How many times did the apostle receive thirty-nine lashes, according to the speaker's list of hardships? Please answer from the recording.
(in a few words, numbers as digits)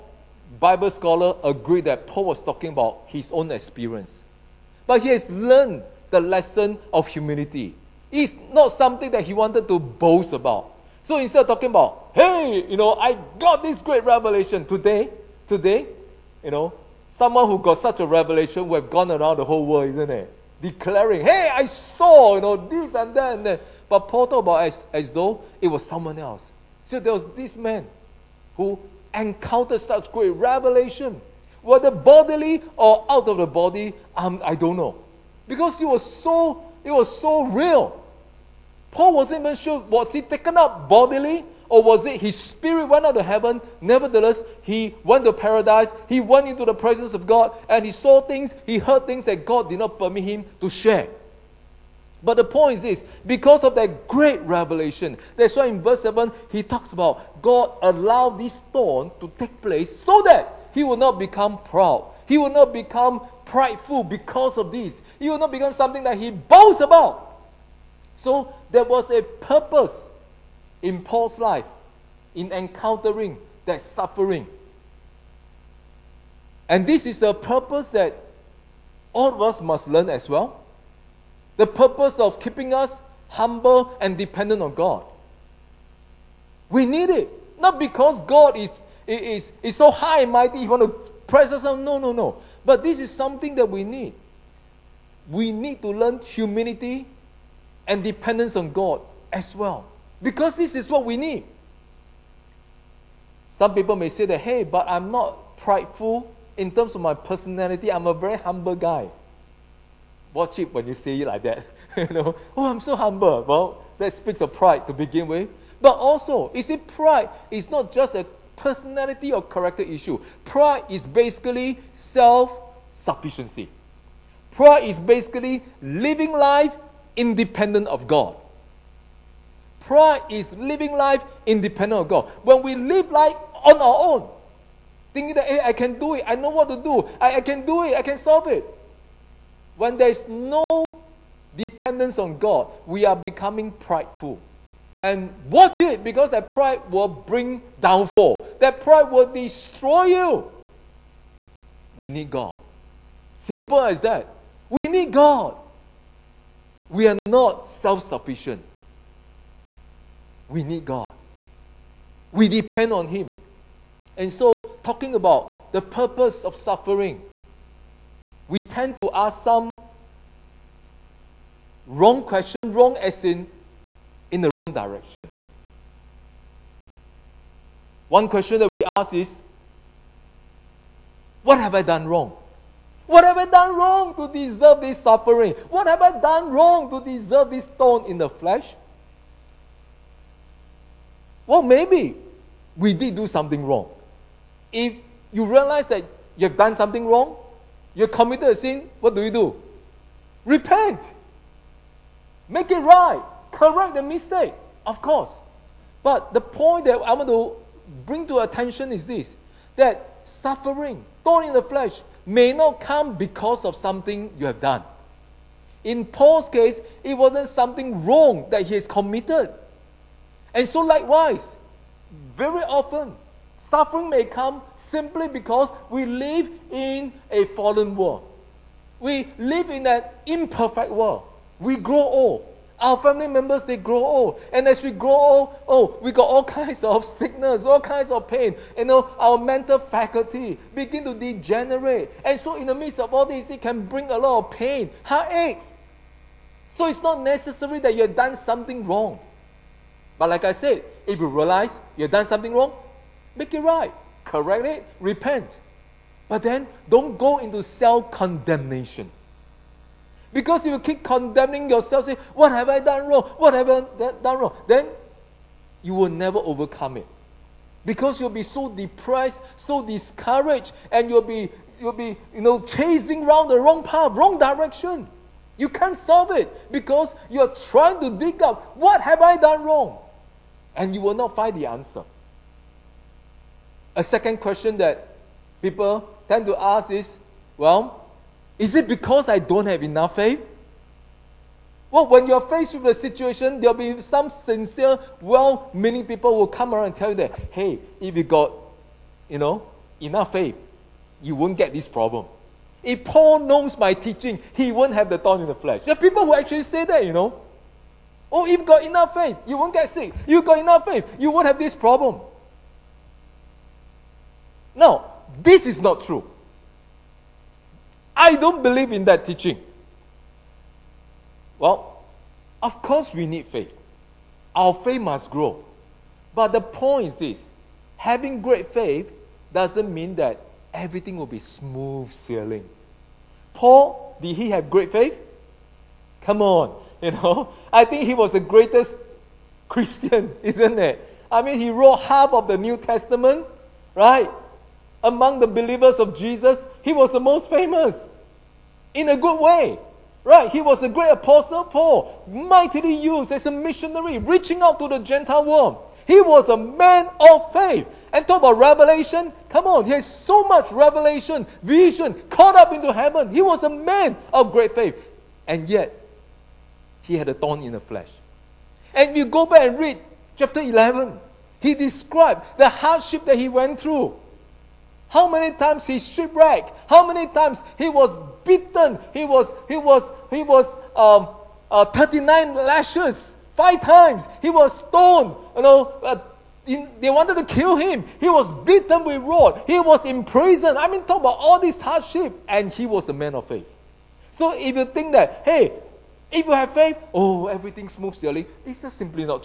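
5.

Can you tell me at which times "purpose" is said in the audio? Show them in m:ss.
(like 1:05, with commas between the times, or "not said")
1:09, 1:17, 1:21, 2:45.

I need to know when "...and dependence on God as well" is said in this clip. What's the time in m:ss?
1:37.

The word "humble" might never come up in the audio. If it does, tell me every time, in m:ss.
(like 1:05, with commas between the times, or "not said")
1:23, 1:48, 1:52.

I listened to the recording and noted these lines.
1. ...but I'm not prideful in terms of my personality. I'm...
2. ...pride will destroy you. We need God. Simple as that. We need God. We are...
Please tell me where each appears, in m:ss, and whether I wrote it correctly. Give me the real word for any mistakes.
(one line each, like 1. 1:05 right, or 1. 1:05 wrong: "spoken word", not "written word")
1. 1:44 right
2. 2:28 right.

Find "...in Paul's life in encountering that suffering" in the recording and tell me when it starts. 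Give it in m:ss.
1:10.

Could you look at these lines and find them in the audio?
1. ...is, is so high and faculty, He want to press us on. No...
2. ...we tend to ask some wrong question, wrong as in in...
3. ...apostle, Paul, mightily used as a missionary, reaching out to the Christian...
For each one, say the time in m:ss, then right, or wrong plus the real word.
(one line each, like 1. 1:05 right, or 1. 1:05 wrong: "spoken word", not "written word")
1. 1:29 wrong: "mighty", not "faculty"
2. 2:48 right
3. 5:51 wrong: "Gentile", not "Christian".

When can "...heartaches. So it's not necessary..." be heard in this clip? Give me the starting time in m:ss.
4:05.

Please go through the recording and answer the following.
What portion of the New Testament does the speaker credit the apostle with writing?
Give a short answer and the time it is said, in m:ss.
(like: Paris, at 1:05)
Half, at 5:42.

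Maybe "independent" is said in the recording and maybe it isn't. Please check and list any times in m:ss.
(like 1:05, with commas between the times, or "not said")
2:07, 2:11.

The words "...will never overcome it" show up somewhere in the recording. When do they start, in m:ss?
4:25.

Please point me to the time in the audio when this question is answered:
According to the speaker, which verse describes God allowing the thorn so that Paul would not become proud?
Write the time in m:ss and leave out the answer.
0:55.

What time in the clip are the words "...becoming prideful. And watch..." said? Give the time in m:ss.
2:23.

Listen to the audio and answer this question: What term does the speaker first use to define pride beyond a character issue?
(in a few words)
Self sufficiency.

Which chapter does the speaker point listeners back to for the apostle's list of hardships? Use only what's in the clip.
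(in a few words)
Chapter 11.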